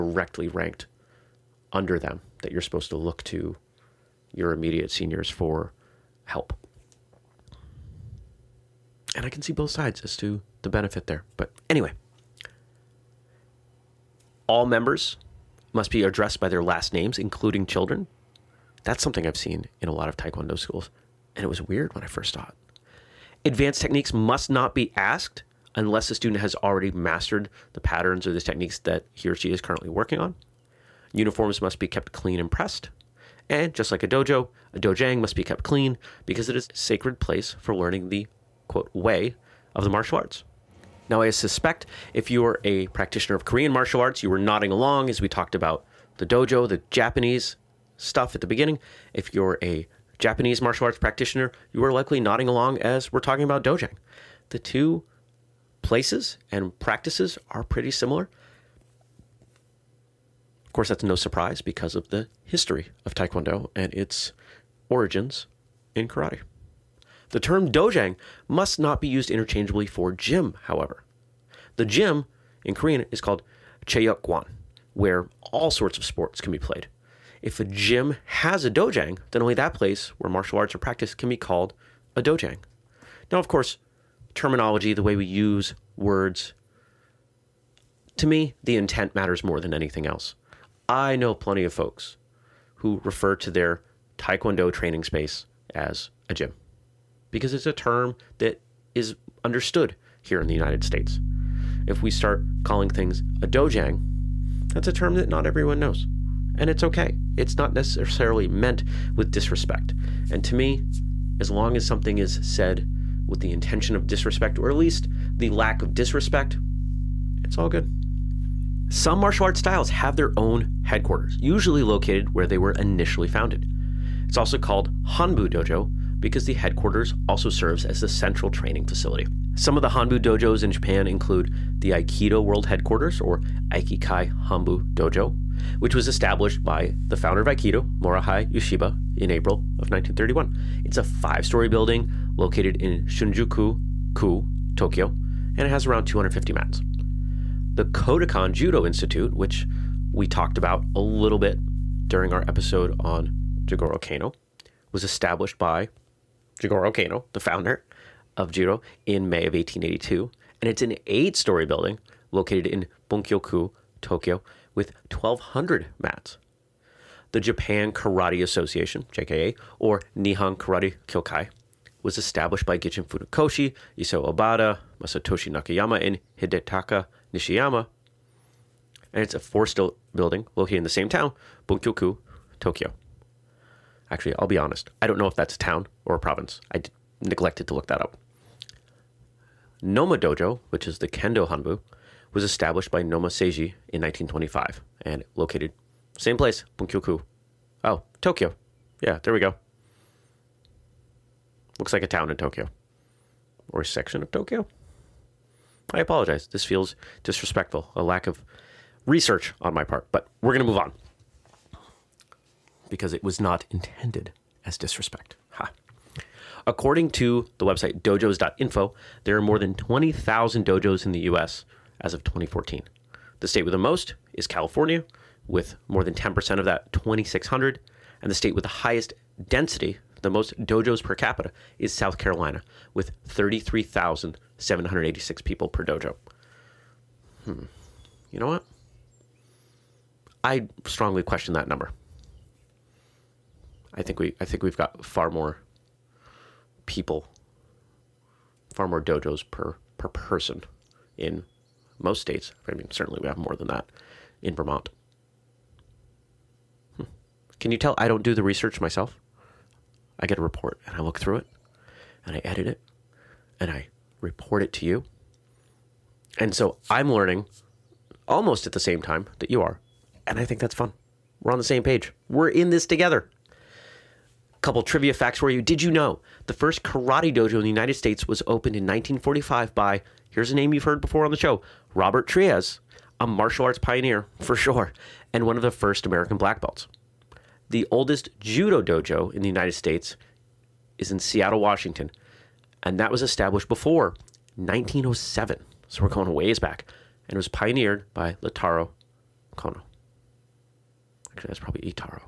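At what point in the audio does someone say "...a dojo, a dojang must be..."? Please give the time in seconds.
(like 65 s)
34 s.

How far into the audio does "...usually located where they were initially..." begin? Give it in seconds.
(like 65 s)
121 s.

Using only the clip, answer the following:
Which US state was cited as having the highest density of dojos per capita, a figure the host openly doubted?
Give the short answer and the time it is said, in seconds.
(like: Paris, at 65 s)
South Carolina, at 231 s.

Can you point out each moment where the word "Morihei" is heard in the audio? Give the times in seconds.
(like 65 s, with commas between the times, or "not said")
138 s.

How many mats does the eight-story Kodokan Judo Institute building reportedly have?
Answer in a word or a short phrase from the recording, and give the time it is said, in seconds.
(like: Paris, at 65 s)
1,200, at 165 s.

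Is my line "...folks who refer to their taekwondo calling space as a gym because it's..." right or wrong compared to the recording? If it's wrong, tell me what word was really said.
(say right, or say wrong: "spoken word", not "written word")
wrong: "training", not "calling".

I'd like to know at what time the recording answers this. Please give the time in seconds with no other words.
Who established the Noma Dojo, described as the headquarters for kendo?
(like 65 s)
193 s.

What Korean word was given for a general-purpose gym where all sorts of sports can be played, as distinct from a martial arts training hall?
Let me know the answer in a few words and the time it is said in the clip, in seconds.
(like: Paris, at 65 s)
cheyokwan, at 73 s.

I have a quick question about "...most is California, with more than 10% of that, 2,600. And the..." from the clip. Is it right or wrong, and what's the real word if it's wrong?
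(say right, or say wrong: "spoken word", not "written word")
right.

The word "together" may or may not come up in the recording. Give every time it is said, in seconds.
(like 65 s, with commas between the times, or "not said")
272 s.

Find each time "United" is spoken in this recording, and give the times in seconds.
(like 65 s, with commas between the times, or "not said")
100 s, 277 s, 289 s.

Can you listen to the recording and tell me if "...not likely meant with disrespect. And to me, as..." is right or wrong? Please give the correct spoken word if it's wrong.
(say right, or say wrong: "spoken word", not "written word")
wrong: "necessarily", not "likely".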